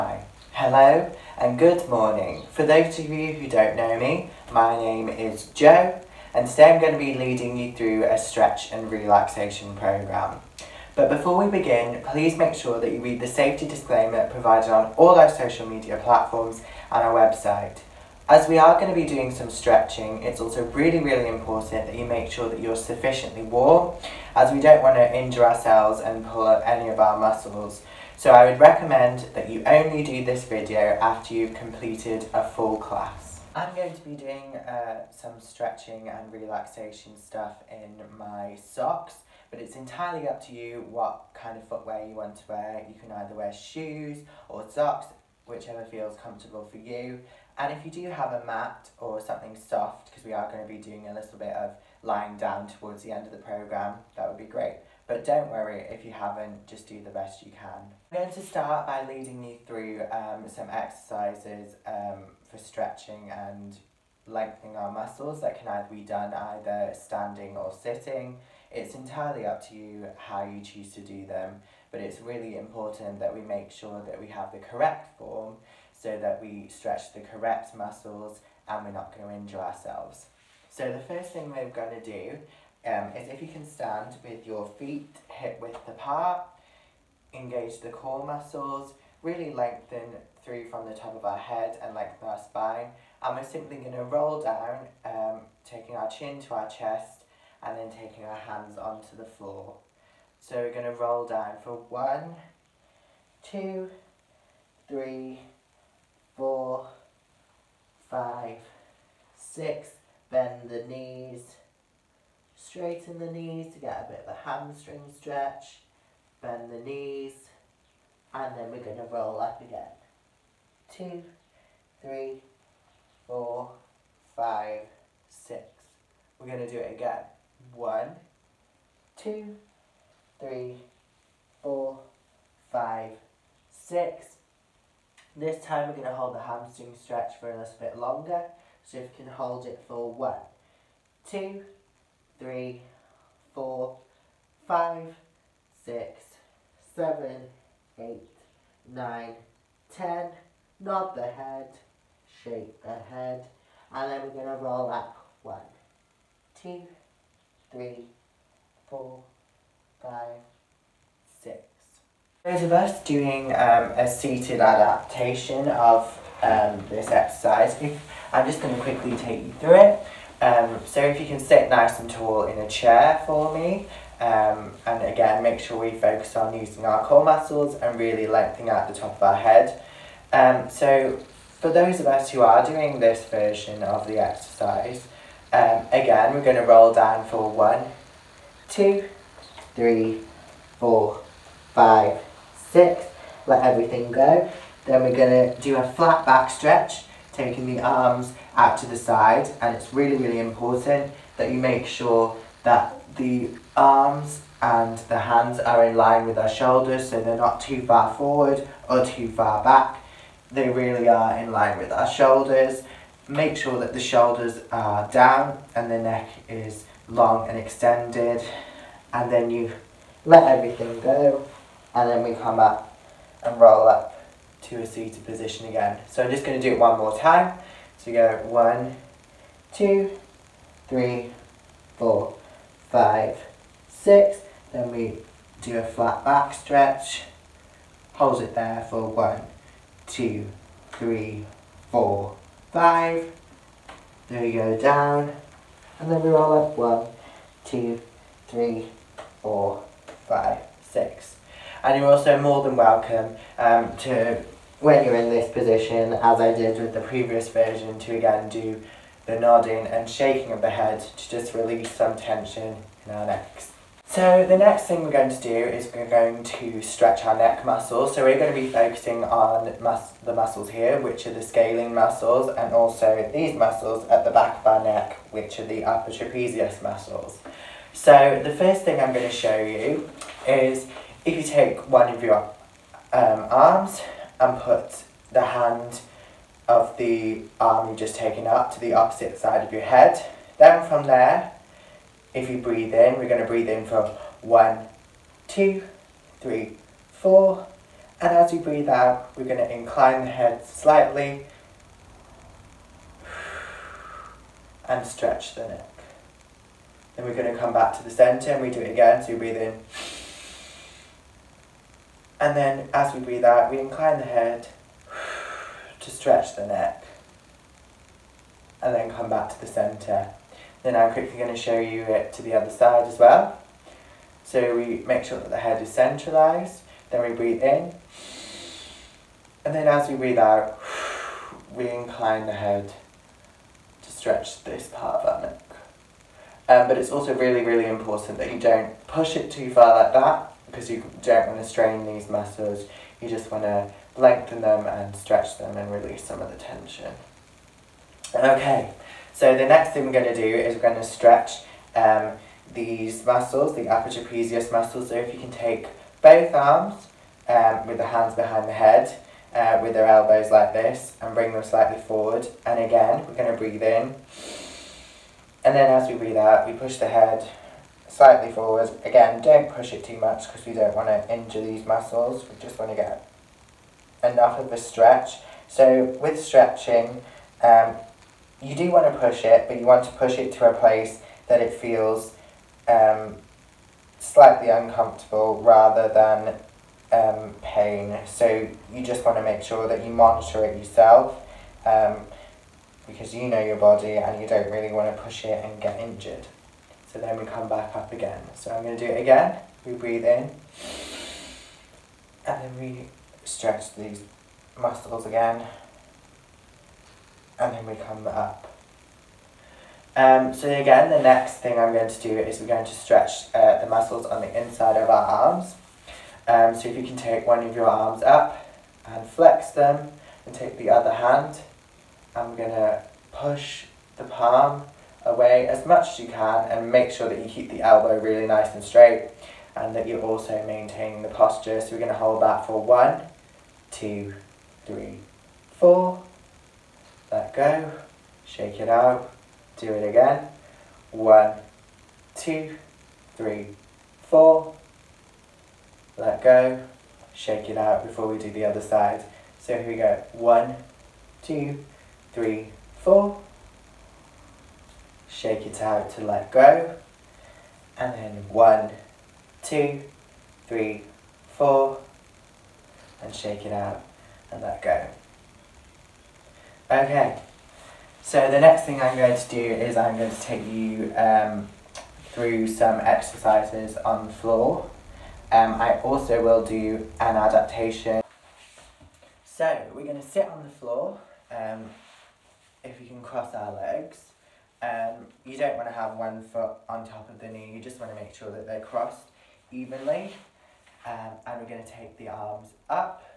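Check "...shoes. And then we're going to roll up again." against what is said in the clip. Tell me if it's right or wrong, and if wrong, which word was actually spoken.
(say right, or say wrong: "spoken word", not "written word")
wrong: "knees", not "shoes".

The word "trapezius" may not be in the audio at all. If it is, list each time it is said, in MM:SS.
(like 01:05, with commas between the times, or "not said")
04:36, 05:54.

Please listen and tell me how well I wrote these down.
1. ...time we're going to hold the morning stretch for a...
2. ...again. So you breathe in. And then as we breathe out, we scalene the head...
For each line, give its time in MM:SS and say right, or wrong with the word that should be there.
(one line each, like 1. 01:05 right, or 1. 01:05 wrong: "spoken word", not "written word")
1. 02:15 wrong: "hamstring", not "morning"
2. 05:08 wrong: "incline", not "scalene".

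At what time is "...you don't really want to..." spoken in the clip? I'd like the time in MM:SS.
06:34.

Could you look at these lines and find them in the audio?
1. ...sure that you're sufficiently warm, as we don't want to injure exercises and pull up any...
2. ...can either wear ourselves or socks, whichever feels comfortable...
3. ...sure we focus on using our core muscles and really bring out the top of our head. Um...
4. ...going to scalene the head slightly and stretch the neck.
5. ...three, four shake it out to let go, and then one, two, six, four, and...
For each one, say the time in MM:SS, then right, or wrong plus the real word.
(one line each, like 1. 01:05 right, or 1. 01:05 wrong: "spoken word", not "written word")
1. 00:22 wrong: "ourselves", not "exercises"
2. 00:42 wrong: "shoes", not "ourselves"
3. 02:55 wrong: "lengthening", not "bring"
4. 04:59 wrong: "incline", not "scalene"
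5. 07:32 wrong: "three", not "six".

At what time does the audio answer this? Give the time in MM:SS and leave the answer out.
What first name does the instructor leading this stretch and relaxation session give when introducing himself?
00:05.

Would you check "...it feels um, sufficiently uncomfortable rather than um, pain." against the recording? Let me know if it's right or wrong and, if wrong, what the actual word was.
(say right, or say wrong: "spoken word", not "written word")
wrong: "slightly", not "sufficiently".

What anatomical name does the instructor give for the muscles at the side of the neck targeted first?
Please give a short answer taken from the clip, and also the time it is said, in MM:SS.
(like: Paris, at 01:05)
scalene muscles, at 04:31.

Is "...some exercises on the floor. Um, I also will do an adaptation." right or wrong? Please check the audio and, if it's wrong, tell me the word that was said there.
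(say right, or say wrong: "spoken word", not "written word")
right.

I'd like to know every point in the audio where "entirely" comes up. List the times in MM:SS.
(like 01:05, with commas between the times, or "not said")
00:39, 01:08.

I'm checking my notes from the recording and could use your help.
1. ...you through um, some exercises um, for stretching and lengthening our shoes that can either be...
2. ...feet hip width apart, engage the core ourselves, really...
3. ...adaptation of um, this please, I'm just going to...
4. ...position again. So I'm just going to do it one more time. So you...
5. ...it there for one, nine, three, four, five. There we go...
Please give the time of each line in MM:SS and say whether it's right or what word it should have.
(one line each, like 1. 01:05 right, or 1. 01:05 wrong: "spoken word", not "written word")
1. 00:59 wrong: "muscles", not "shoes"
2. 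01:24 wrong: "muscles", not "ourselves"
3. 02:44 wrong: "exercise", not "please"
4. 03:45 right
5. 03:58 wrong: "two", not "nine".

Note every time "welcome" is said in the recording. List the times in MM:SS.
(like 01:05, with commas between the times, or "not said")
04:12.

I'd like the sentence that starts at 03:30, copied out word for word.
They really are in line with our shoulders.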